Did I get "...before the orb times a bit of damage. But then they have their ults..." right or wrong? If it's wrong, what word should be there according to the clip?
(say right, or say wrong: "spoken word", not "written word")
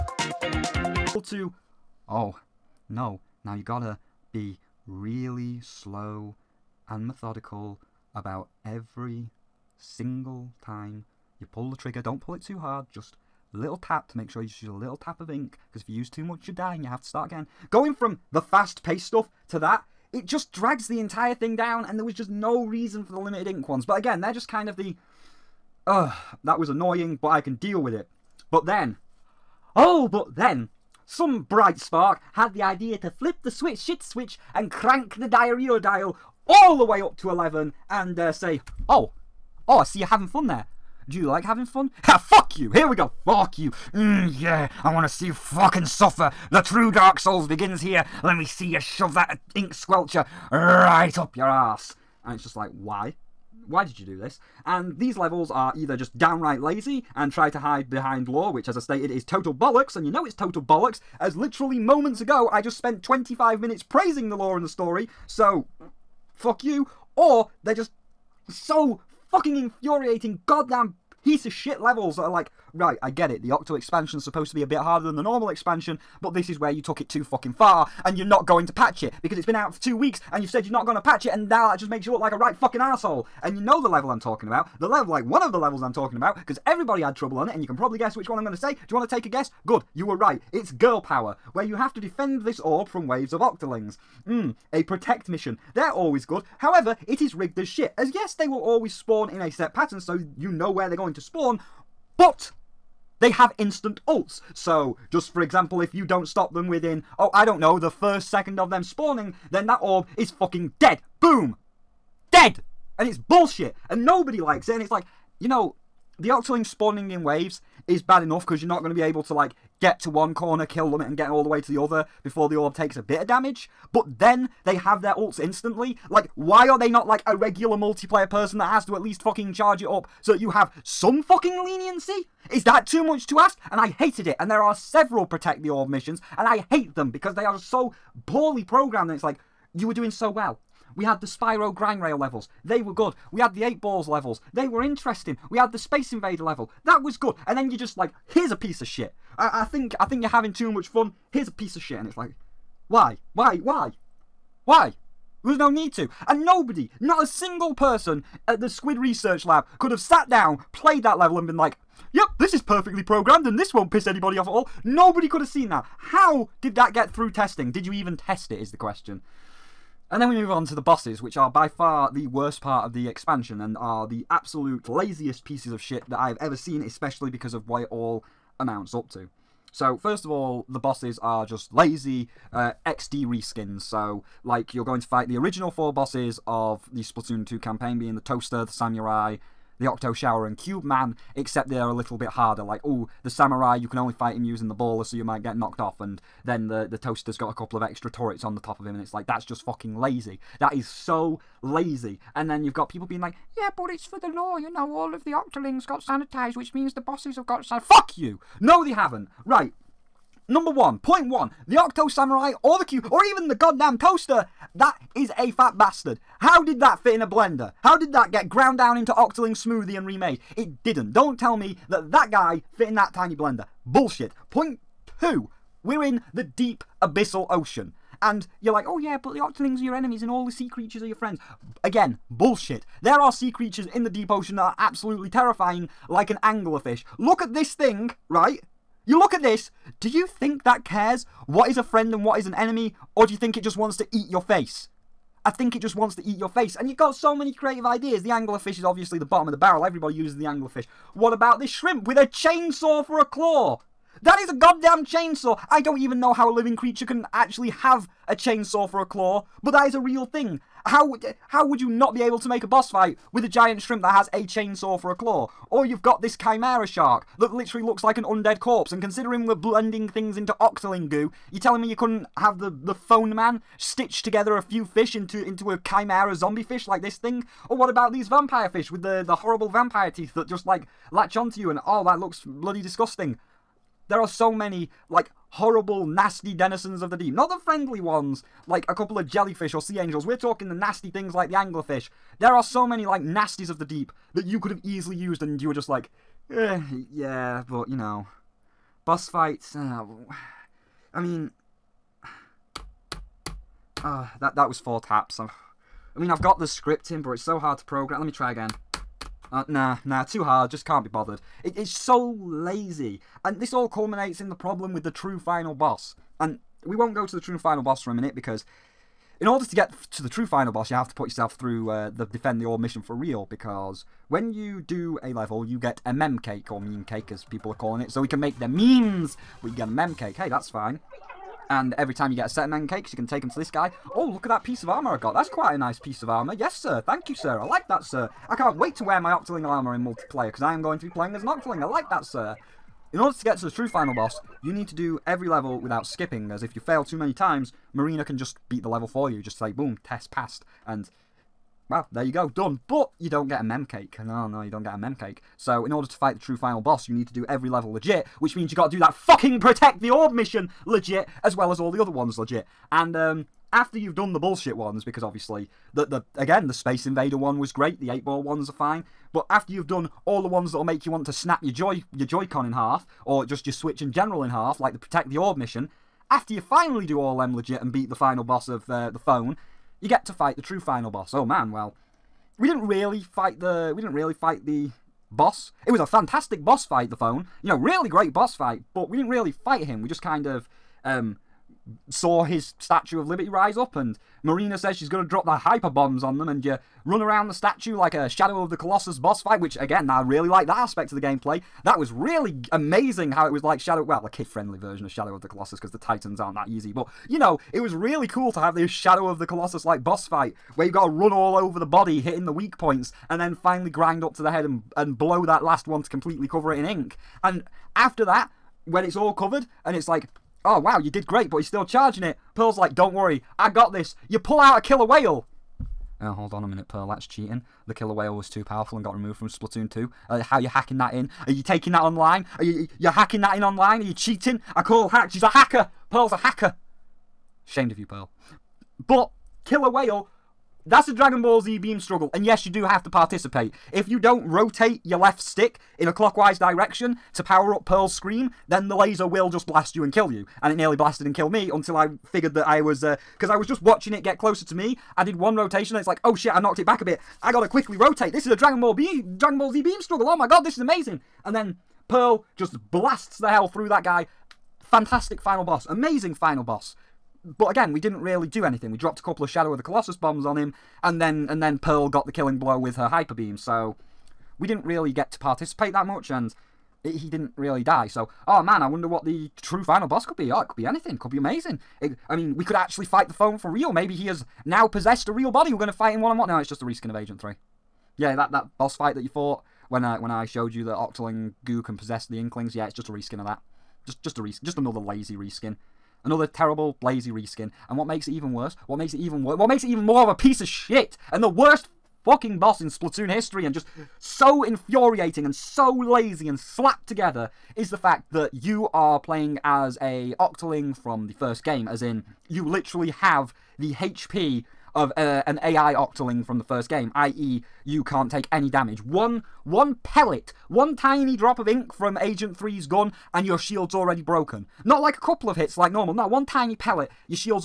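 wrong: "takes", not "times".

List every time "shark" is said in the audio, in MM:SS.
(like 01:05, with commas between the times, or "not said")
04:26.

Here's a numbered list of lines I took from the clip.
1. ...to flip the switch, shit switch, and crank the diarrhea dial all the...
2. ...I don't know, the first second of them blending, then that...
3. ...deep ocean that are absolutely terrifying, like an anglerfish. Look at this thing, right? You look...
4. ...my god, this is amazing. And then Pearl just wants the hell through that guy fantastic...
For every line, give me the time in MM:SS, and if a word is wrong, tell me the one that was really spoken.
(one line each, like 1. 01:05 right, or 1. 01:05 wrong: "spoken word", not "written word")
1. 00:32 right
2. 01:47 wrong: "spawning", not "blending"
3. 03:54 right
4. 07:40 wrong: "blasts", not "wants".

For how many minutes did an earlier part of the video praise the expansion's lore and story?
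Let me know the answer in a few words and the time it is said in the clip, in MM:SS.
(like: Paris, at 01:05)
25, at 01:03.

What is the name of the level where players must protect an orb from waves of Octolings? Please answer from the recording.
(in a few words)
Girl Power.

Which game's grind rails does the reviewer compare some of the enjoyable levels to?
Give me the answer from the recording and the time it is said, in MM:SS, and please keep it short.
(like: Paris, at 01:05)
Spyro, at 02:21.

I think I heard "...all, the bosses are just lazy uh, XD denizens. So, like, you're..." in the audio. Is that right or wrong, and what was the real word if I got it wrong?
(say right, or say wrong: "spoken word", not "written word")
wrong: "reskins", not "denizens".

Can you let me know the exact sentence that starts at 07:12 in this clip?
Are you you hacking that in online?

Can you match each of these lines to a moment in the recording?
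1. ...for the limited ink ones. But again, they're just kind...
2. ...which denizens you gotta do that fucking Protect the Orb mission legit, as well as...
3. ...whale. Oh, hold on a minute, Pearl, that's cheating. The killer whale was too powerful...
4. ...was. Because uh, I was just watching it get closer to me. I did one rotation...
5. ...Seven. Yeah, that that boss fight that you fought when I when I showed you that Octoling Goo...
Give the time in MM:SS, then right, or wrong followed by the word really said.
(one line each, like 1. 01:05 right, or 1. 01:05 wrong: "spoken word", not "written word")
1. 00:23 right
2. 05:58 wrong: "means", not "denizens"
3. 07:05 right
4. 07:32 right
5. 08:07 wrong: "Three", not "Seven".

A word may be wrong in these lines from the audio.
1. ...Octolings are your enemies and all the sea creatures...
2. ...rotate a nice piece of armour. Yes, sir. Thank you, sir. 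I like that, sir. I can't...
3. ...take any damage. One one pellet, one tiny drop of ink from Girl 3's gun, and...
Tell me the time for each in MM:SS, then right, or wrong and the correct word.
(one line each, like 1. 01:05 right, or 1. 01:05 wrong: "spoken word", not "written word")
1. 03:49 right
2. 05:35 wrong: "quite", not "rotate"
3. 08:38 wrong: "Agent", not "Girl".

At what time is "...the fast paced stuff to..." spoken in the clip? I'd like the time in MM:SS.
00:18.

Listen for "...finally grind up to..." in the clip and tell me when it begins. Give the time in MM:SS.
06:53.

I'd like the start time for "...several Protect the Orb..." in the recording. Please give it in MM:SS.
02:14.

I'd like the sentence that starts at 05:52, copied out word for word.
But you don't get a mem cake.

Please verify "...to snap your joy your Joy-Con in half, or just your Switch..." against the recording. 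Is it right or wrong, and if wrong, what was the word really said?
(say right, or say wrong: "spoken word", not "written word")
right.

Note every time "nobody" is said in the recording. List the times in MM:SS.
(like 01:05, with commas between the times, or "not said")
01:54, 02:36, 02:44.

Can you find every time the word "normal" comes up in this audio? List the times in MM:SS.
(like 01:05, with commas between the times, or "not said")
01:15, 08:45.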